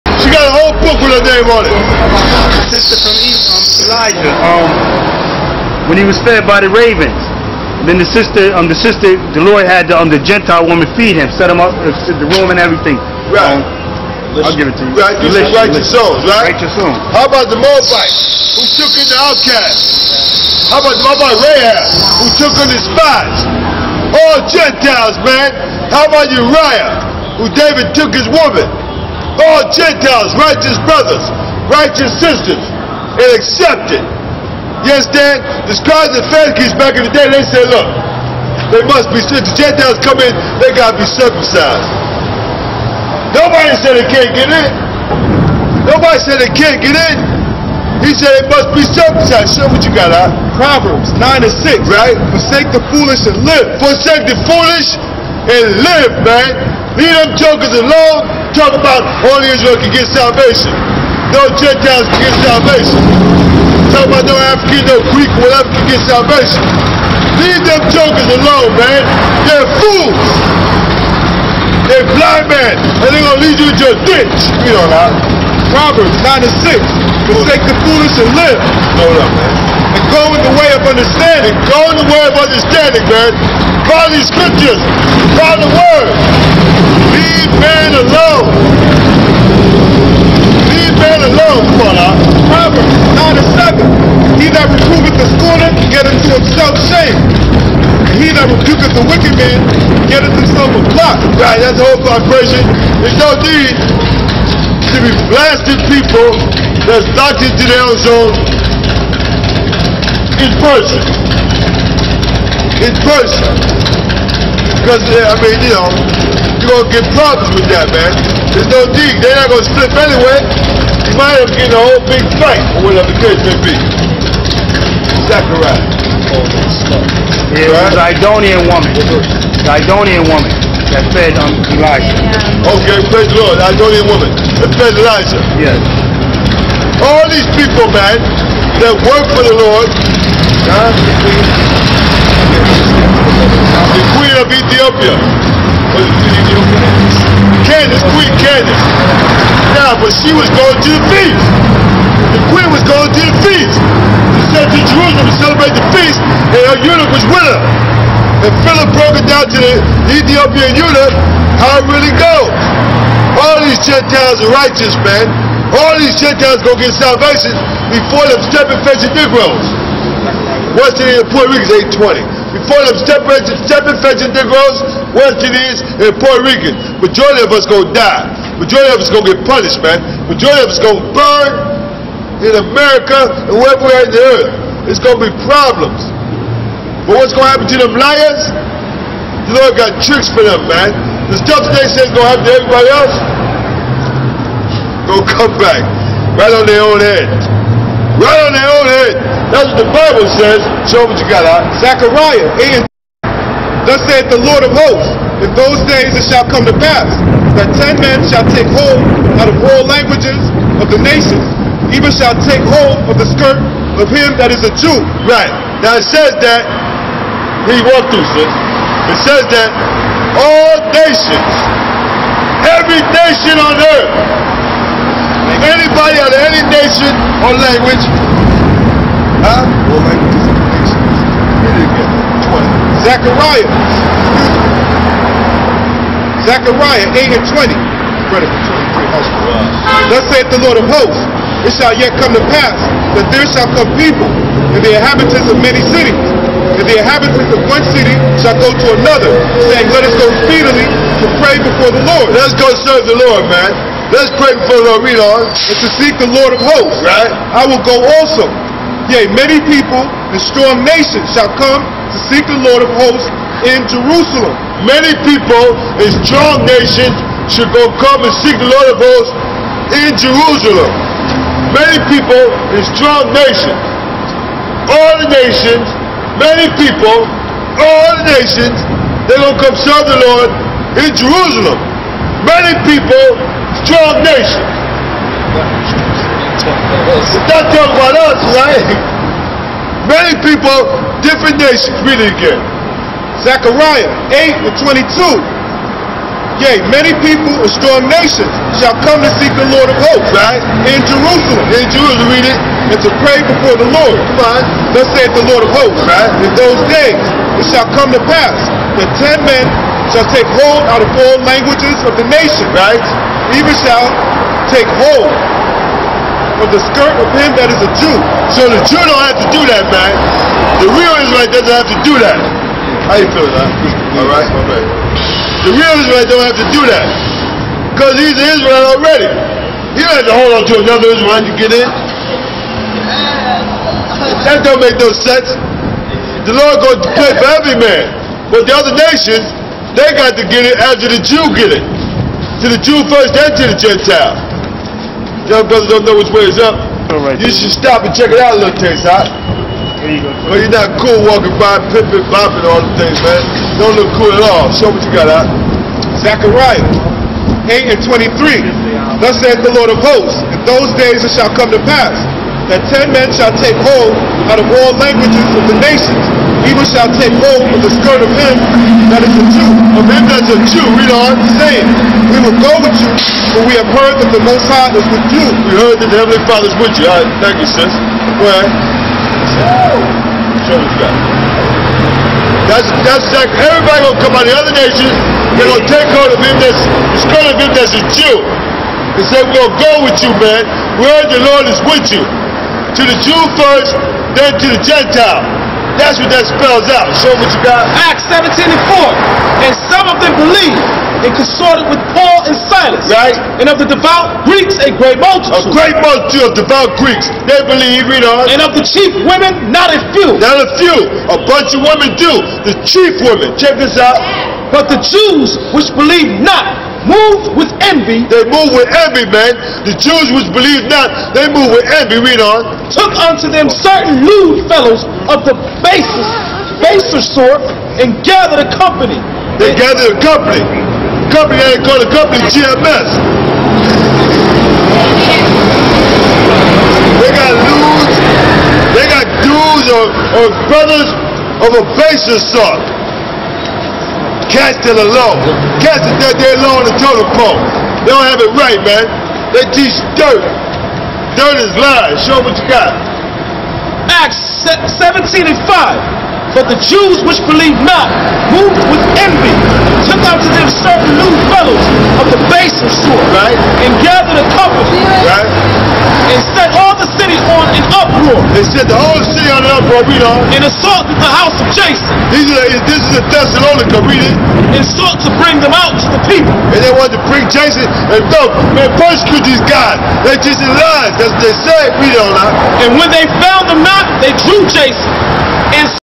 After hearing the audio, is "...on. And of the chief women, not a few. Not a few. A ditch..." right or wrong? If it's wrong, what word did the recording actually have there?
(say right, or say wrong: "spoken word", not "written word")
wrong: "bunch", not "ditch".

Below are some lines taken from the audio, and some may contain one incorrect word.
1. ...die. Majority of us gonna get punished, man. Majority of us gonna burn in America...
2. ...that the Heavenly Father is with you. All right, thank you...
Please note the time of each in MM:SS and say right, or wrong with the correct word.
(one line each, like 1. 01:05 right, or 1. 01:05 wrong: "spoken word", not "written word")
1. 02:57 right
2. 06:15 right.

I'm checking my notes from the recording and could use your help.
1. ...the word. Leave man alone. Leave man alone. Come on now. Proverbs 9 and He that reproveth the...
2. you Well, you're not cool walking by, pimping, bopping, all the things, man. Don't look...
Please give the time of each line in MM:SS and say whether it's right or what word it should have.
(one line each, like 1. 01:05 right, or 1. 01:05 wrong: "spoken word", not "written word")
1. 01:25 right
2. 05:50 right.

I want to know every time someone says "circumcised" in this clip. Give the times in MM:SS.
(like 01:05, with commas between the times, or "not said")
00:41, 00:48.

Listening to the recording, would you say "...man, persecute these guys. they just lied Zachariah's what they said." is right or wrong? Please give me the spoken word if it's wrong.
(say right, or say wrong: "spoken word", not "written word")
wrong: "That", not "Zachariah".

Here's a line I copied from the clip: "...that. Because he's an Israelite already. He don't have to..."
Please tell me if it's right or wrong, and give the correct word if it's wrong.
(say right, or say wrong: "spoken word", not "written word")
right.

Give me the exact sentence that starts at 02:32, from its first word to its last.
The queen was going to the feast.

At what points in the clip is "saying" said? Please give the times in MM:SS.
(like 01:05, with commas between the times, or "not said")
04:09, 06:11.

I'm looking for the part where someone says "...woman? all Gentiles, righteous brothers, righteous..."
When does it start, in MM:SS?
00:28.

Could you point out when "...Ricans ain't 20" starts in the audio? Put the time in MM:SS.
02:51.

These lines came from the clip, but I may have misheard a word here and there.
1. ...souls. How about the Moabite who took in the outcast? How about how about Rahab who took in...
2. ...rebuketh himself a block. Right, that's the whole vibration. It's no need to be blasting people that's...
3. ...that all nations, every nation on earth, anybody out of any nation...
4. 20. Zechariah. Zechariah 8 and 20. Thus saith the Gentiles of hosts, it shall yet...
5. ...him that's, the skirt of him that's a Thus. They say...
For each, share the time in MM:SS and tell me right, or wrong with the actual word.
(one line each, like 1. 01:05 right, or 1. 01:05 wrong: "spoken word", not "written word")
1. 00:16 right
2. 01:40 wrong: "getteth", not "rebuketh"
3. 03:39 right
4. 03:53 wrong: "Lord", not "Gentiles"
5. 06:26 wrong: "Jew", not "Thus".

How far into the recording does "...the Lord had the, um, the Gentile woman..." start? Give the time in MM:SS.
00:09.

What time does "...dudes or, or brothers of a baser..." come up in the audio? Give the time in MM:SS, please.
07:19.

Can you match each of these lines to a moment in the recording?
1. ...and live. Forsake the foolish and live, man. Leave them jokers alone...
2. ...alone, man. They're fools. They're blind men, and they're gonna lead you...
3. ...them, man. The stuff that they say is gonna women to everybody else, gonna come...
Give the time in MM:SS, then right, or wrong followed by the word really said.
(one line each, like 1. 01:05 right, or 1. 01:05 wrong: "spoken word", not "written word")
1. 00:53 right
2. 01:08 right
3. 03:10 wrong: "happen", not "women".